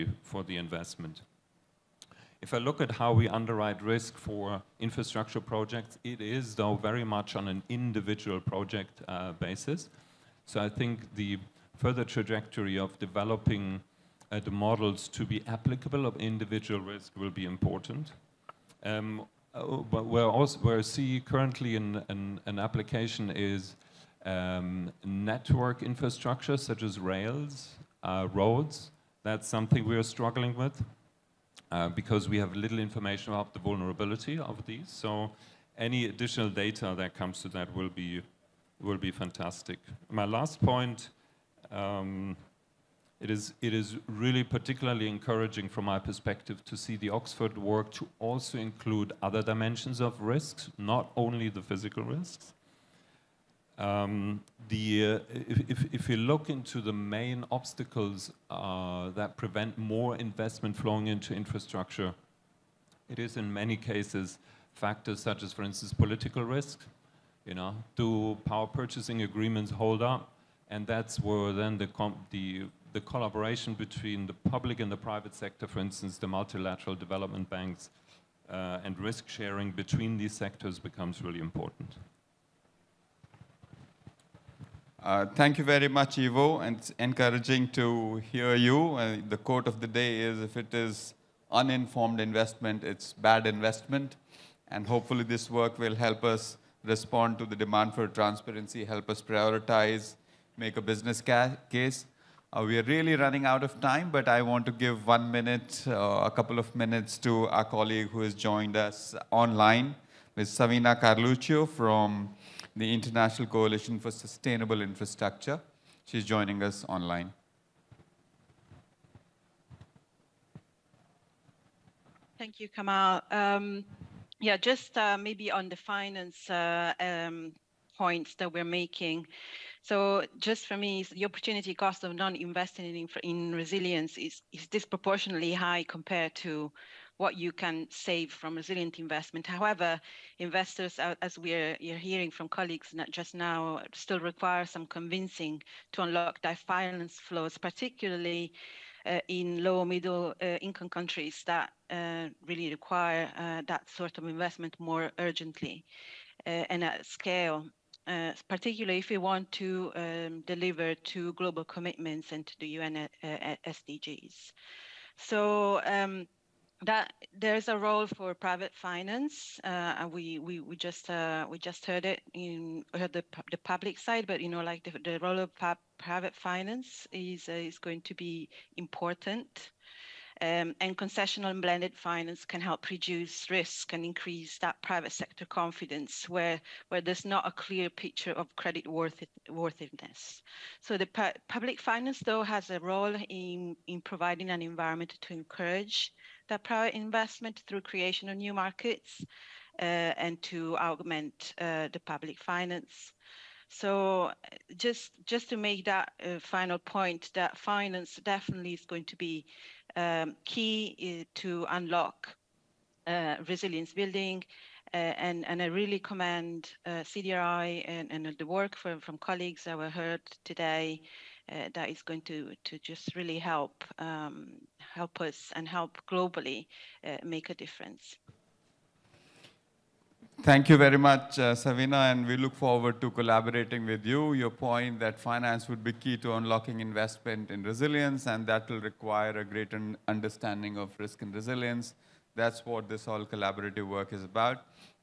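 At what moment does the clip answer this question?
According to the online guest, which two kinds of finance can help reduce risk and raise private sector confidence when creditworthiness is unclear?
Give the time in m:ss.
3:00.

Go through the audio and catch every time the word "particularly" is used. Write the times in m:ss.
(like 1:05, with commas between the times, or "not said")
0:44, 2:27, 2:38.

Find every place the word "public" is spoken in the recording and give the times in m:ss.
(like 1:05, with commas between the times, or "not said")
1:14, 2:53, 3:11, 3:22.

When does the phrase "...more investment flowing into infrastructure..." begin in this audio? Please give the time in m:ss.
0:59.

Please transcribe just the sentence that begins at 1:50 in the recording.
Savina Carluccio from the International Coalition for Sustainable Infrastructure.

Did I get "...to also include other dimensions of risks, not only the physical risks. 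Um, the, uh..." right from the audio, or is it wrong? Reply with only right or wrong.
right.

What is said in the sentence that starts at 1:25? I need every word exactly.
Uh, thank you very much, Ivo, and it's encouraging to hear you.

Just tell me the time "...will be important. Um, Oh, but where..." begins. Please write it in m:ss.
0:17.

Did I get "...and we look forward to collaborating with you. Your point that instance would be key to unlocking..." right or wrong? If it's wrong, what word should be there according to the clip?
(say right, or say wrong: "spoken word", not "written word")
wrong: "finance", not "instance".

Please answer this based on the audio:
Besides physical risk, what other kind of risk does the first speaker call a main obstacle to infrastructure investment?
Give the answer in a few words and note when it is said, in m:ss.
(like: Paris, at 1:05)
political risk, at 1:05.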